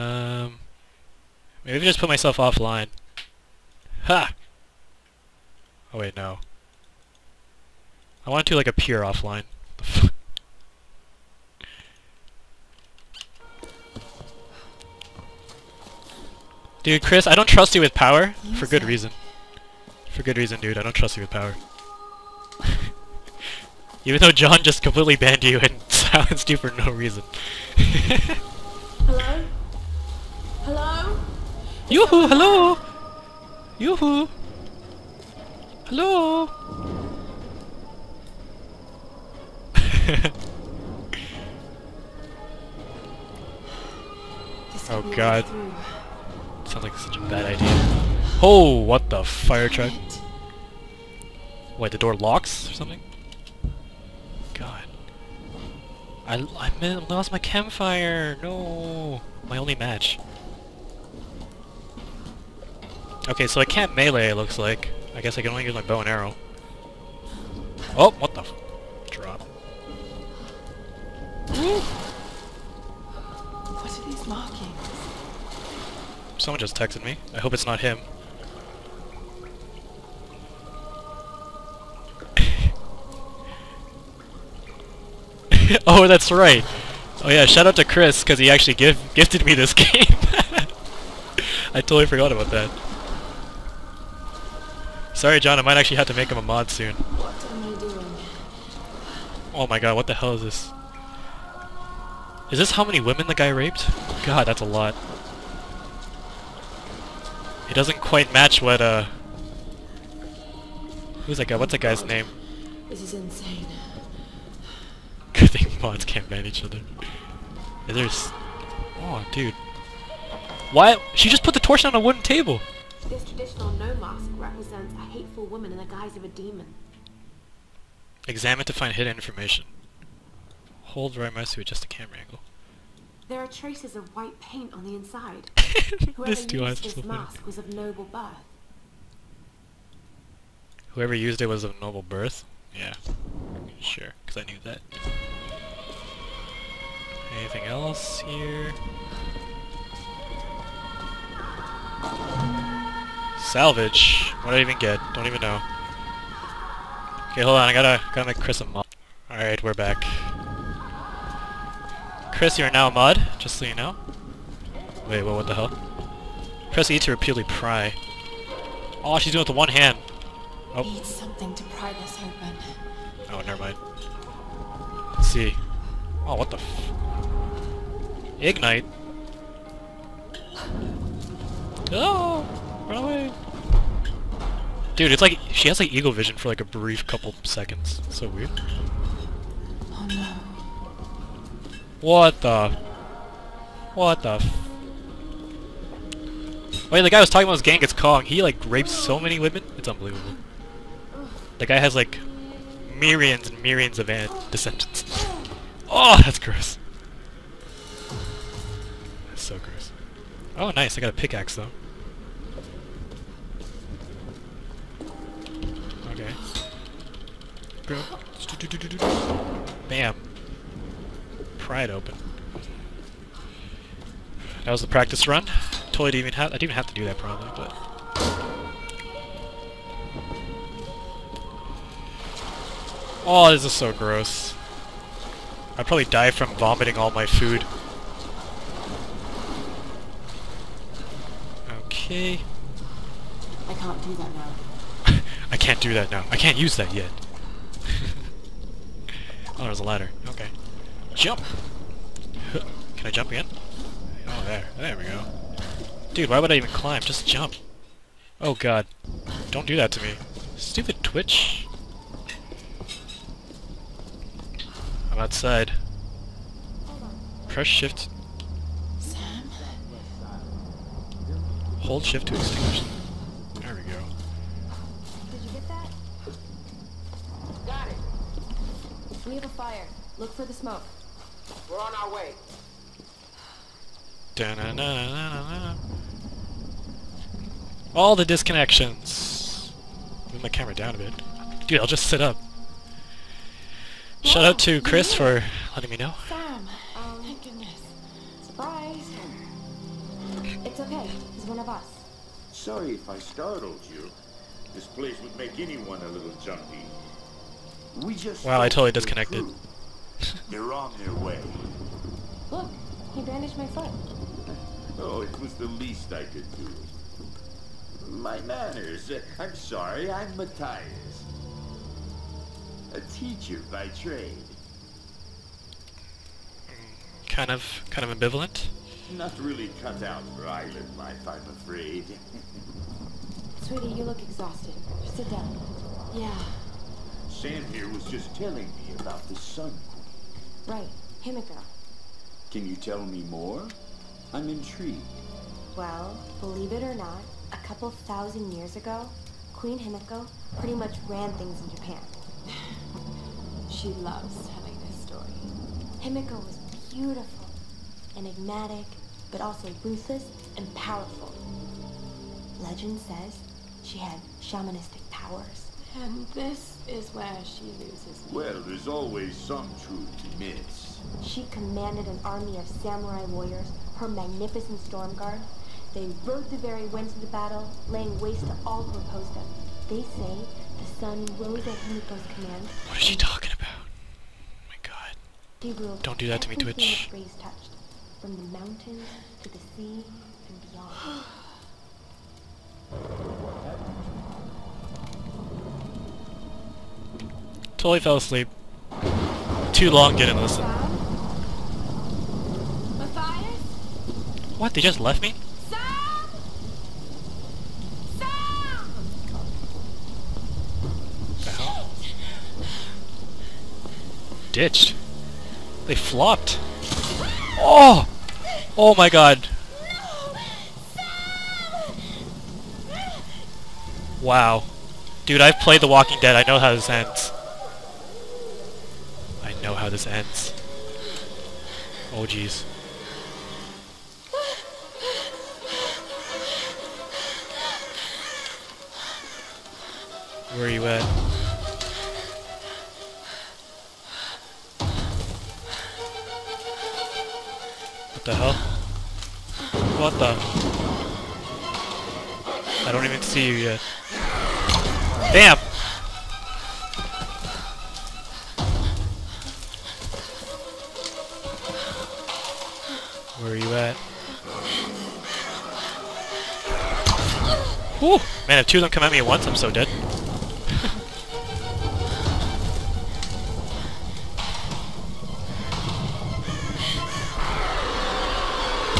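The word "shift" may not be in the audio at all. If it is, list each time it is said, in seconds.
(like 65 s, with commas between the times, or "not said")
267 s, 272 s.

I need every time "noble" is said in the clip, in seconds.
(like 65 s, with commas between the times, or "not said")
137 s, 141 s.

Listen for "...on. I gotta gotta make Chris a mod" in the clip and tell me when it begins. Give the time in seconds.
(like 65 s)
157 s.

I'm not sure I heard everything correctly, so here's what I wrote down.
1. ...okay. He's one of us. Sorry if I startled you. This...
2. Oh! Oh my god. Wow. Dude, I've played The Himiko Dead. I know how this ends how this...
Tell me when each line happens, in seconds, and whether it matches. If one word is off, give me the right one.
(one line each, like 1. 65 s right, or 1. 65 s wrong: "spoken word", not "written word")
1. 300 s right
2. 417 s wrong: "Walking", not "Himiko".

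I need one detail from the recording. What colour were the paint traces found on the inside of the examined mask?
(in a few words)
White.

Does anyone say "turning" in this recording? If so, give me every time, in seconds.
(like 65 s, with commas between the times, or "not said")
not said.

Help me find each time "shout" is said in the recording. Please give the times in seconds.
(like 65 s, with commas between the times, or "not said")
87 s, 294 s.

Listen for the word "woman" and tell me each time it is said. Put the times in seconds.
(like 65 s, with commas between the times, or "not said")
125 s.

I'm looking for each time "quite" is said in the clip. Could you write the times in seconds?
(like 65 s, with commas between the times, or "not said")
108 s.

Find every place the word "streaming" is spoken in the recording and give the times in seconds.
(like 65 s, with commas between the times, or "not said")
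not said.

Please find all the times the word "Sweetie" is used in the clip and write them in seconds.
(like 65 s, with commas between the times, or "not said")
333 s.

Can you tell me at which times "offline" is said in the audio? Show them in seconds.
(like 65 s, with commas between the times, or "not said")
2 s, 8 s.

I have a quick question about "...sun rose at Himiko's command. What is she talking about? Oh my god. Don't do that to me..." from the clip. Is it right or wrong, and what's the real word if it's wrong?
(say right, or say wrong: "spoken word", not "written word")
right.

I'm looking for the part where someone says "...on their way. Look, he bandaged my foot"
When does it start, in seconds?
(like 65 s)
310 s.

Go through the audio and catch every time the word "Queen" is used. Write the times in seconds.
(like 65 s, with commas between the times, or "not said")
339 s, 349 s.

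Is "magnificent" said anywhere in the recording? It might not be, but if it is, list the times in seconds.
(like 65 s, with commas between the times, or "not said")
374 s.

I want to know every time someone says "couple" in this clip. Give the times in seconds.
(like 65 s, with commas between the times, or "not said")
187 s, 347 s.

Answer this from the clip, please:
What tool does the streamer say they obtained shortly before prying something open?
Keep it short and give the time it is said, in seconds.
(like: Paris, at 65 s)
Pickaxe, at 211 s.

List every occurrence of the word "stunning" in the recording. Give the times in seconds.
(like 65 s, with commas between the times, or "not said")
not said.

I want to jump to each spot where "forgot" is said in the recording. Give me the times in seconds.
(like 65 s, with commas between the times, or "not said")
92 s.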